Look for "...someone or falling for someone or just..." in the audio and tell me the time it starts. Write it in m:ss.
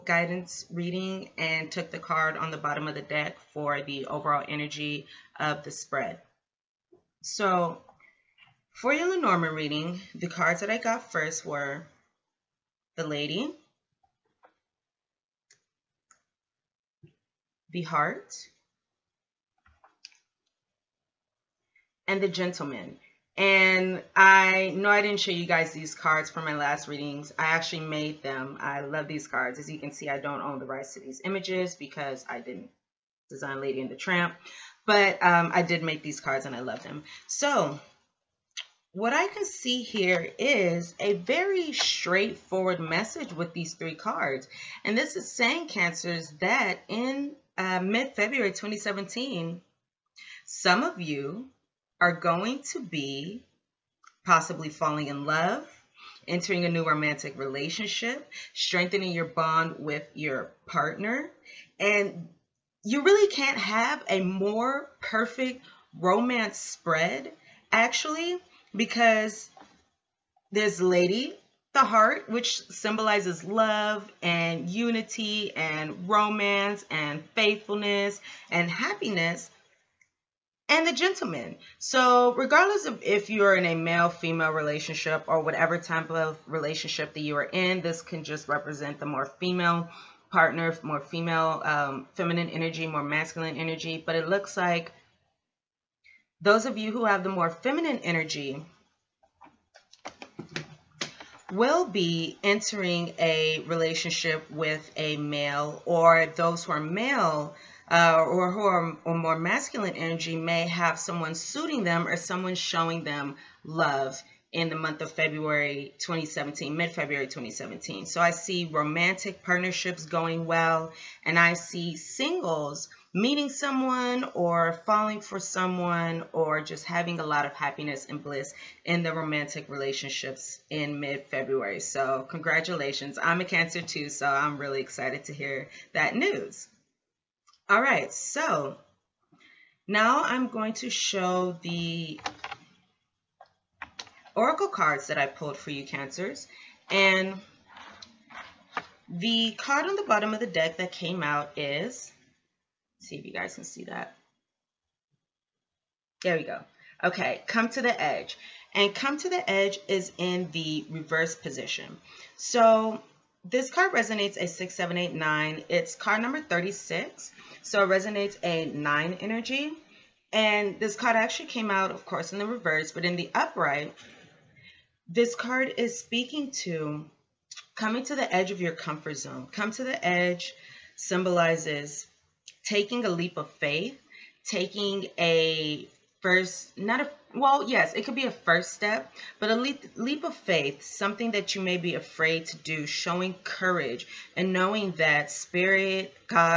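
2:03.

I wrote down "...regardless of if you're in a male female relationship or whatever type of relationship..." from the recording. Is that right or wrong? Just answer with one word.
right.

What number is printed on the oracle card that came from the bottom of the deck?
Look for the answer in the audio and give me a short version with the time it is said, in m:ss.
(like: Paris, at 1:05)
36, at 2:46.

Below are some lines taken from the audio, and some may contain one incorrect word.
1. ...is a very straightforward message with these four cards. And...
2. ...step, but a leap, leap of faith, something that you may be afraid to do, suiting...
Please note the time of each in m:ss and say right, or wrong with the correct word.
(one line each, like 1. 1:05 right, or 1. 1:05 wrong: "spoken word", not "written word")
1. 0:40 wrong: "three", not "four"
2. 3:08 wrong: "showing", not "suiting".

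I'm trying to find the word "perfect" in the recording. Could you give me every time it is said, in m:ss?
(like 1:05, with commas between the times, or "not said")
1:05.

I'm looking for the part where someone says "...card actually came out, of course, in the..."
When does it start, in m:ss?
2:50.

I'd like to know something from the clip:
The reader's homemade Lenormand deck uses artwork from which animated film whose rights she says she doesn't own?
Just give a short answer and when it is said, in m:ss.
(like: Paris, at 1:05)
Lady and the Tramp, at 0:33.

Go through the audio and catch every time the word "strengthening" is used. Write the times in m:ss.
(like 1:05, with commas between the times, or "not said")
0:58.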